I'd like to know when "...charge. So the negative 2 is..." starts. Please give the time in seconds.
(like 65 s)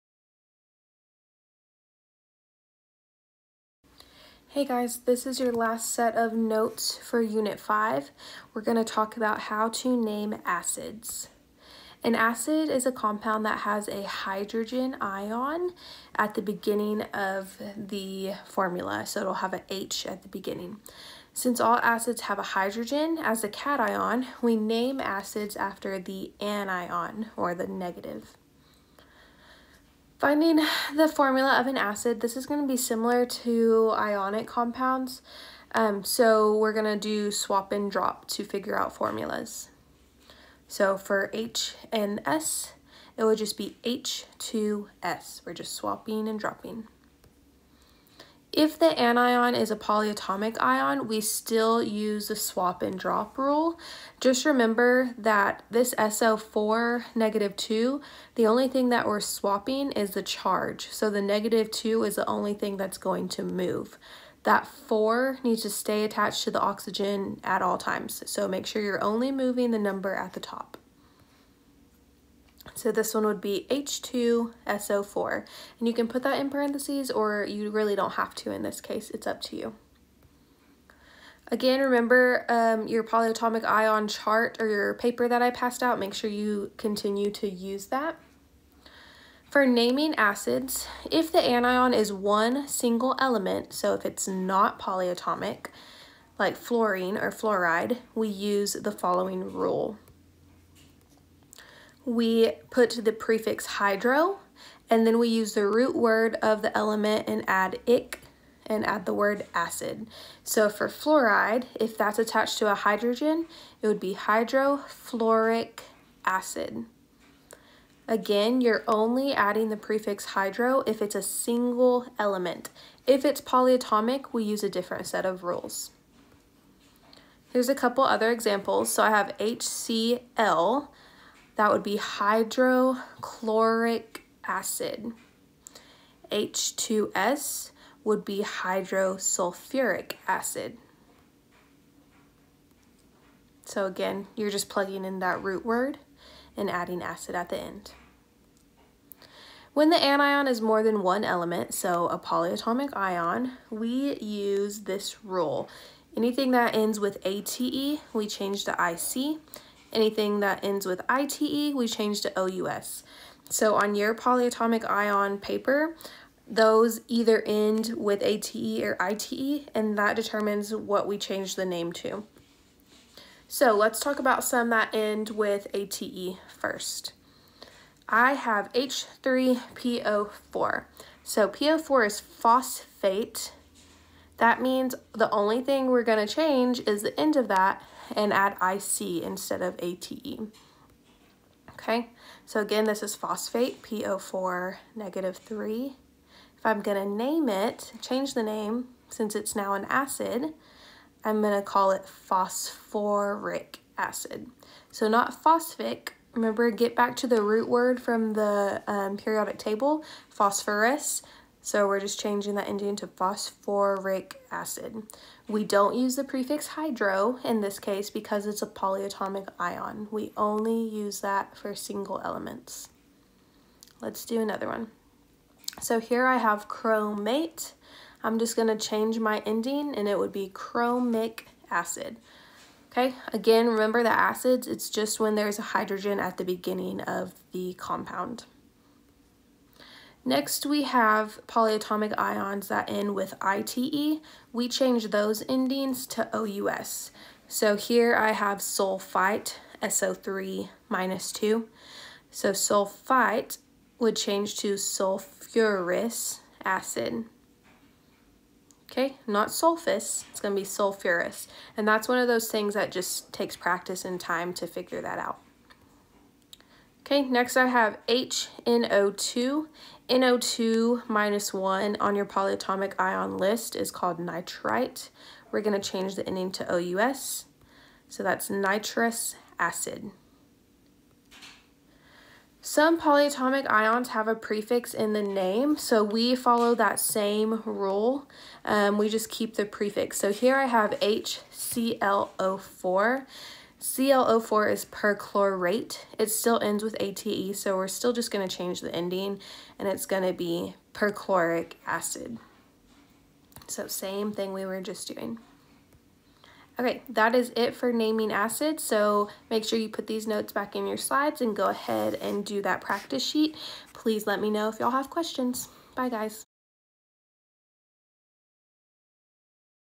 60 s.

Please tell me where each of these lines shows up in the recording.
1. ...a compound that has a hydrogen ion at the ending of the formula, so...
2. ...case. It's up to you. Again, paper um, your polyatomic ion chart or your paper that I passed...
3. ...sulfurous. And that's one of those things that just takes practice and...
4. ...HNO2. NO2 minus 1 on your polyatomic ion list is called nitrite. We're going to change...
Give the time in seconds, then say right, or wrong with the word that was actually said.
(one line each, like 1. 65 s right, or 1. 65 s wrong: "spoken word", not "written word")
1. 12 s wrong: "beginning", not "ending"
2. 78 s wrong: "remember", not "paper"
3. 260 s right
4. 268 s right.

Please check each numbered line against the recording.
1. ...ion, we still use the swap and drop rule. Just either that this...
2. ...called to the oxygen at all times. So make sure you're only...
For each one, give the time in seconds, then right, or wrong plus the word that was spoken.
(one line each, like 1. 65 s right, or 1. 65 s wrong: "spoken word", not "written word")
1. 50 s wrong: "remember", not "either"
2. 66 s wrong: "attached", not "called".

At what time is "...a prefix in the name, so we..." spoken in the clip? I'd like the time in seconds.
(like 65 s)
284 s.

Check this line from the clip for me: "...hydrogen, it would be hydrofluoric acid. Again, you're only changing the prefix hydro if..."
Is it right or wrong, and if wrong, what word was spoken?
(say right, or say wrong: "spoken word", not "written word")
wrong: "adding", not "changing".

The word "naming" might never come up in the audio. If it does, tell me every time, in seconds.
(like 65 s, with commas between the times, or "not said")
89 s, 307 s.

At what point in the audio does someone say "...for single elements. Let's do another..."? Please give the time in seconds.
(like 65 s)
221 s.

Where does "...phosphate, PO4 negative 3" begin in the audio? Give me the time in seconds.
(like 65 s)
193 s.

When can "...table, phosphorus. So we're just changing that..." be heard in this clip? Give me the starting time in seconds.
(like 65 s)
209 s.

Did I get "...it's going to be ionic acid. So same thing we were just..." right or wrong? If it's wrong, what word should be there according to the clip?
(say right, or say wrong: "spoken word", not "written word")
wrong: "perchloric", not "ionic".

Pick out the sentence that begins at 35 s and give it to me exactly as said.
Um, so we're going to do swap and drop to figure out formulas.